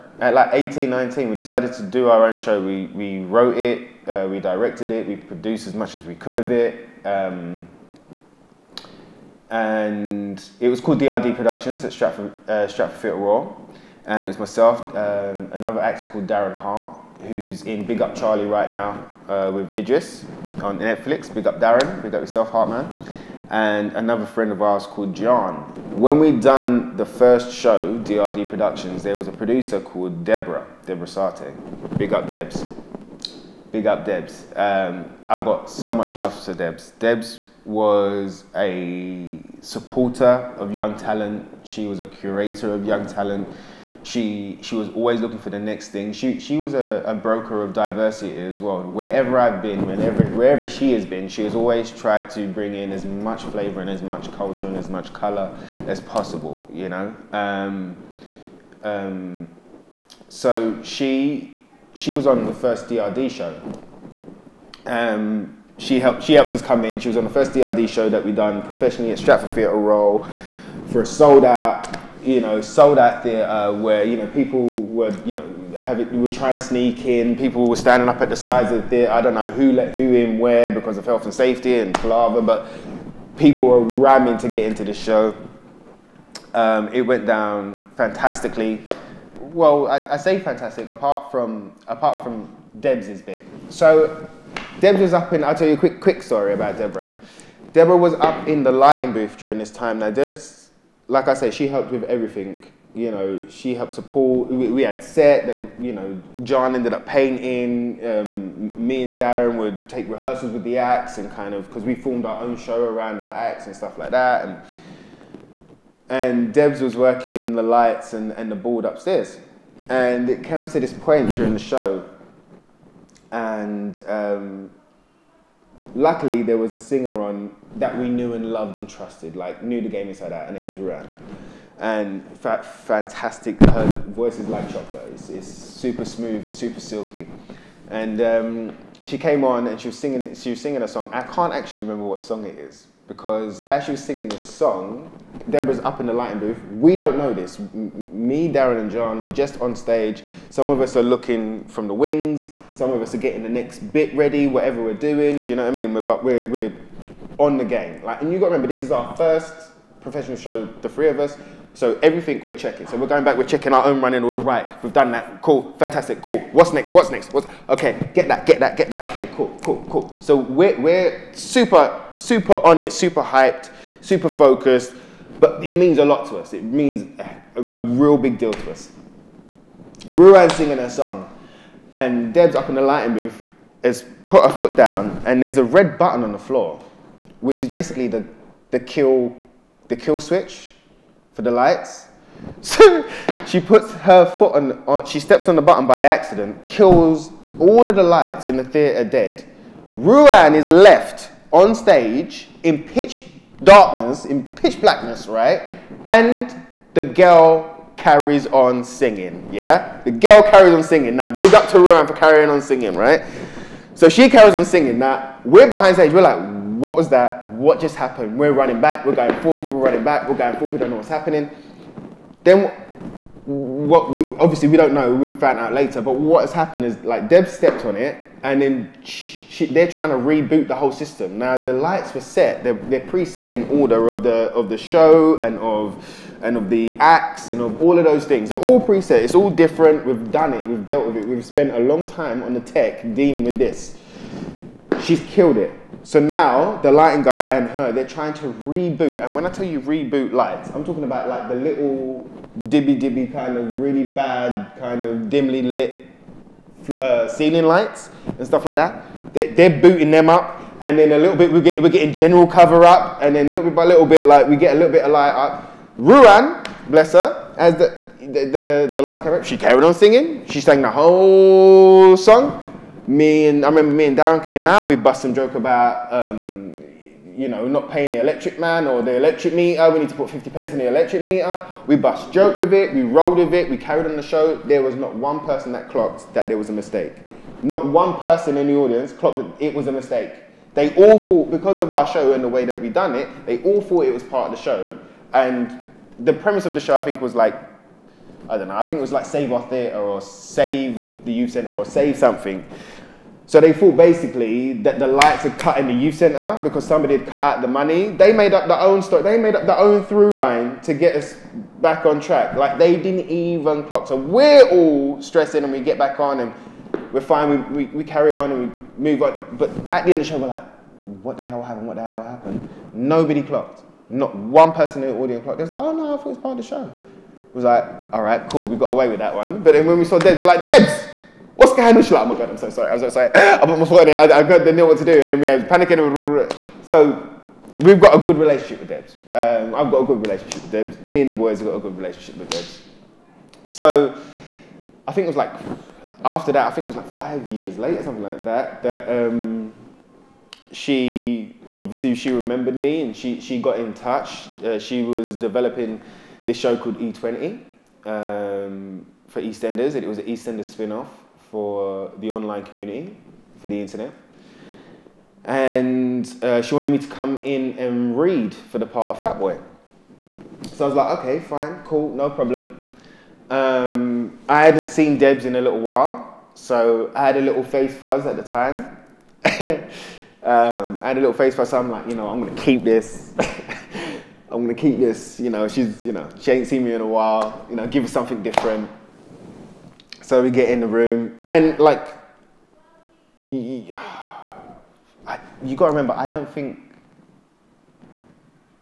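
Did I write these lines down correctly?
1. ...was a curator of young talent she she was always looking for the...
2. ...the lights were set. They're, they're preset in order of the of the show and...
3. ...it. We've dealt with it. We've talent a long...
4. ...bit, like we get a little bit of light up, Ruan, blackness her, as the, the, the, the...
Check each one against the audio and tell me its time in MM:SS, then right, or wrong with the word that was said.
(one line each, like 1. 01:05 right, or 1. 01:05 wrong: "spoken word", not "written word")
1. 00:41 right
2. 03:51 right
3. 04:00 wrong: "spent", not "talent"
4. 04:24 wrong: "bless", not "blackness".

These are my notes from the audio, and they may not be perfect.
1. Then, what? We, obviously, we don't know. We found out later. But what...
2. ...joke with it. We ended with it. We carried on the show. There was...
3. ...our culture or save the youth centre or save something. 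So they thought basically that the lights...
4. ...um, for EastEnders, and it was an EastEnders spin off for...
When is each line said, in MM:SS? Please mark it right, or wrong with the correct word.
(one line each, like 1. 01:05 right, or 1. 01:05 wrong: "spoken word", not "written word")
1. 03:42 right
2. 04:42 wrong: "rolled", not "ended"
3. 04:59 wrong: "theatre", not "culture"
4. 05:58 right.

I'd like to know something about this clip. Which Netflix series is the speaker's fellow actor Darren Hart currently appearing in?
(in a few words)
Big Up Charlie.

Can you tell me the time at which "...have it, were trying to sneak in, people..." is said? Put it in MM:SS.
01:15.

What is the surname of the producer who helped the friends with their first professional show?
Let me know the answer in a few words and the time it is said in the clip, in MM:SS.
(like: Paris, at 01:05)
Sathe, at 00:31.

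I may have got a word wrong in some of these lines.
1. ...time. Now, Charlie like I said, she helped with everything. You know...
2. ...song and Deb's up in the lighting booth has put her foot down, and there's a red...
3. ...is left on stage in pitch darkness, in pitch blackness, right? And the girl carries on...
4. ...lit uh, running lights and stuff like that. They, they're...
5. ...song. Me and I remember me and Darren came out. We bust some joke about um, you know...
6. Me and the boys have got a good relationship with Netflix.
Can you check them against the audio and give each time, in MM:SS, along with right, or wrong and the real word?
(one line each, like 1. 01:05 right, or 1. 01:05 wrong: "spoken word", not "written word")
1. 01:39 wrong: "Debs", not "Charlie"
2. 03:00 right
3. 03:20 right
4. 04:15 wrong: "ceiling", not "running"
5. 04:32 right
6. 05:41 wrong: "Debs", not "Netflix".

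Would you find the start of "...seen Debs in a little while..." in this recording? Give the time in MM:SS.
06:14.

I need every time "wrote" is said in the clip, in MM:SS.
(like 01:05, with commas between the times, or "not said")
00:03.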